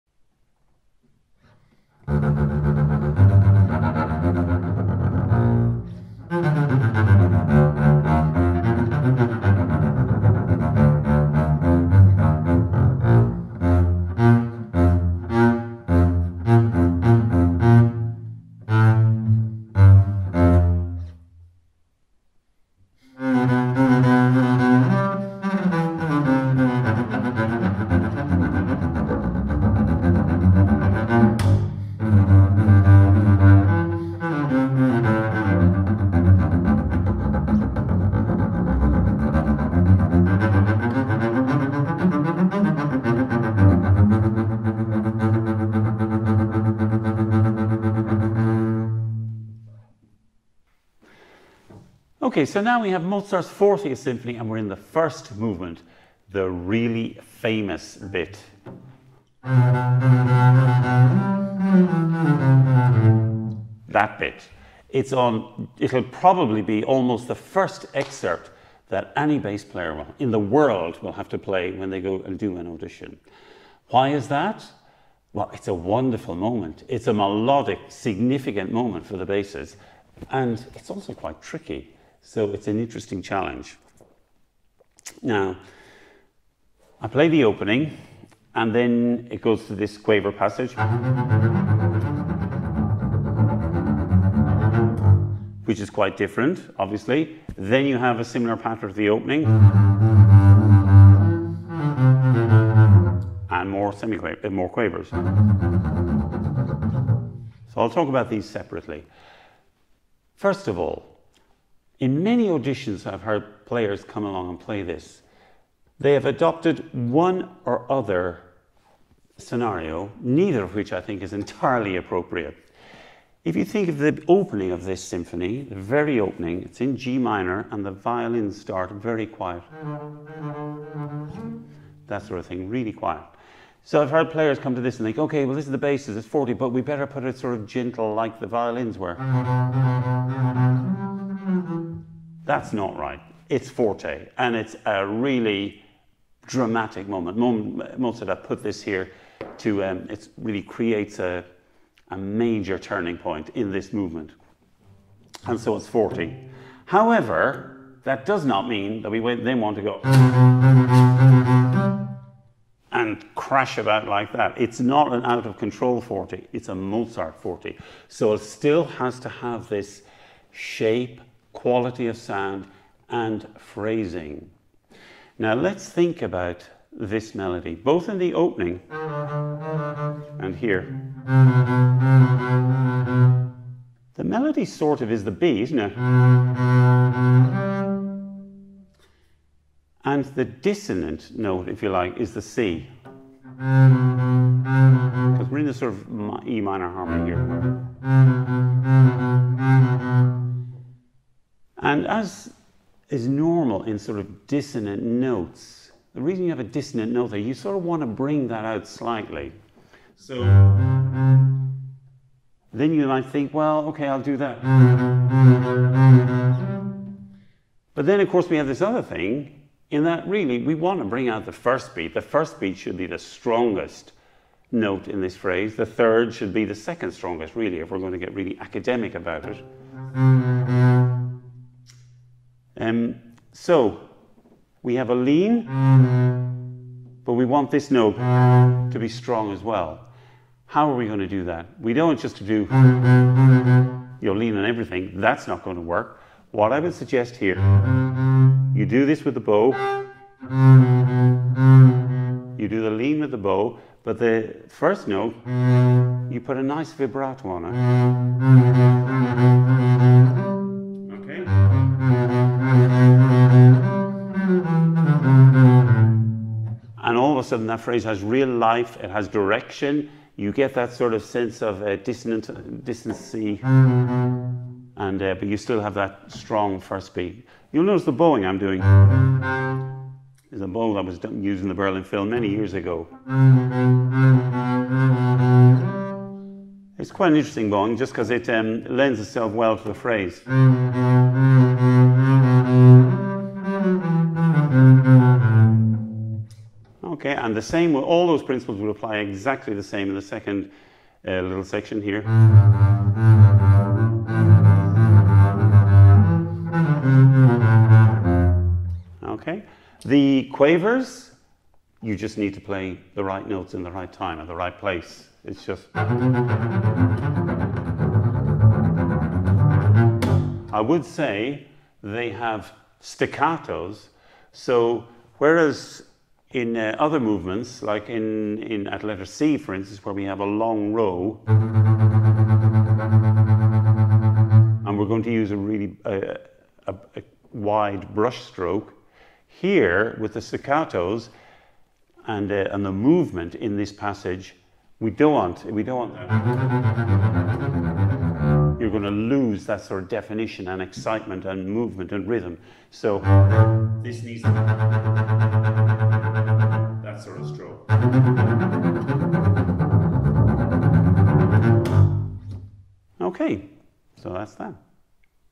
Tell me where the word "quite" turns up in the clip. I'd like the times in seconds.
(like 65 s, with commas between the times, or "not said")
81 s, 95 s, 287 s.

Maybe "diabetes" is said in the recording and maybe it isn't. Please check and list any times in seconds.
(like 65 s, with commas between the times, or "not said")
not said.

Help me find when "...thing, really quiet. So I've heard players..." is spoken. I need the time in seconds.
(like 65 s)
132 s.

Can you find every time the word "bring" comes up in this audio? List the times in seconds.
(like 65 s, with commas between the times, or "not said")
208 s, 221 s.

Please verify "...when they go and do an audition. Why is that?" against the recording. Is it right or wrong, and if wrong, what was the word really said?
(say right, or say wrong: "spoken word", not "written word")
right.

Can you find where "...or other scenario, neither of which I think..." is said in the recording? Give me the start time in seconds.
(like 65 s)
117 s.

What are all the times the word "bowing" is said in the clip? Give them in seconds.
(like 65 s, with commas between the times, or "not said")
278 s, 287 s.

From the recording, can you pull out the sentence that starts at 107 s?
So I'll talk about these separately.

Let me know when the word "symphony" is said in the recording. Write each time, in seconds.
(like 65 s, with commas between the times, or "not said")
53 s, 125 s.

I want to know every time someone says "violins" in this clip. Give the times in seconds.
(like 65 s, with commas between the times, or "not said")
127 s, 138 s.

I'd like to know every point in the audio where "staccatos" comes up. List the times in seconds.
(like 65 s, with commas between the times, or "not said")
322 s, 340 s.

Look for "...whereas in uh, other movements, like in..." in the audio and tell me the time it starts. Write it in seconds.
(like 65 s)
325 s.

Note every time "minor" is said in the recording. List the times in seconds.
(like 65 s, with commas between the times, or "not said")
127 s, 196 s.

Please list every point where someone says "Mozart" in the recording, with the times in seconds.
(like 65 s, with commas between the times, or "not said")
53 s, 147 s, 166 s.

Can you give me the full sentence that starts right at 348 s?
You're going to lose that sort of definition and excitement and movement and rhythm.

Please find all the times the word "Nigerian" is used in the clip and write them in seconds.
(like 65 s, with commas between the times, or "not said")
not said.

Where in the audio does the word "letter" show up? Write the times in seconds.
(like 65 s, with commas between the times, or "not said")
329 s.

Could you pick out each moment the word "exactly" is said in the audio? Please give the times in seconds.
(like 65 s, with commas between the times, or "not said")
299 s.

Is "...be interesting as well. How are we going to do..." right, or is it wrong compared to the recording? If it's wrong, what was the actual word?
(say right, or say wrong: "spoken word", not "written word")
wrong: "strong", not "interesting".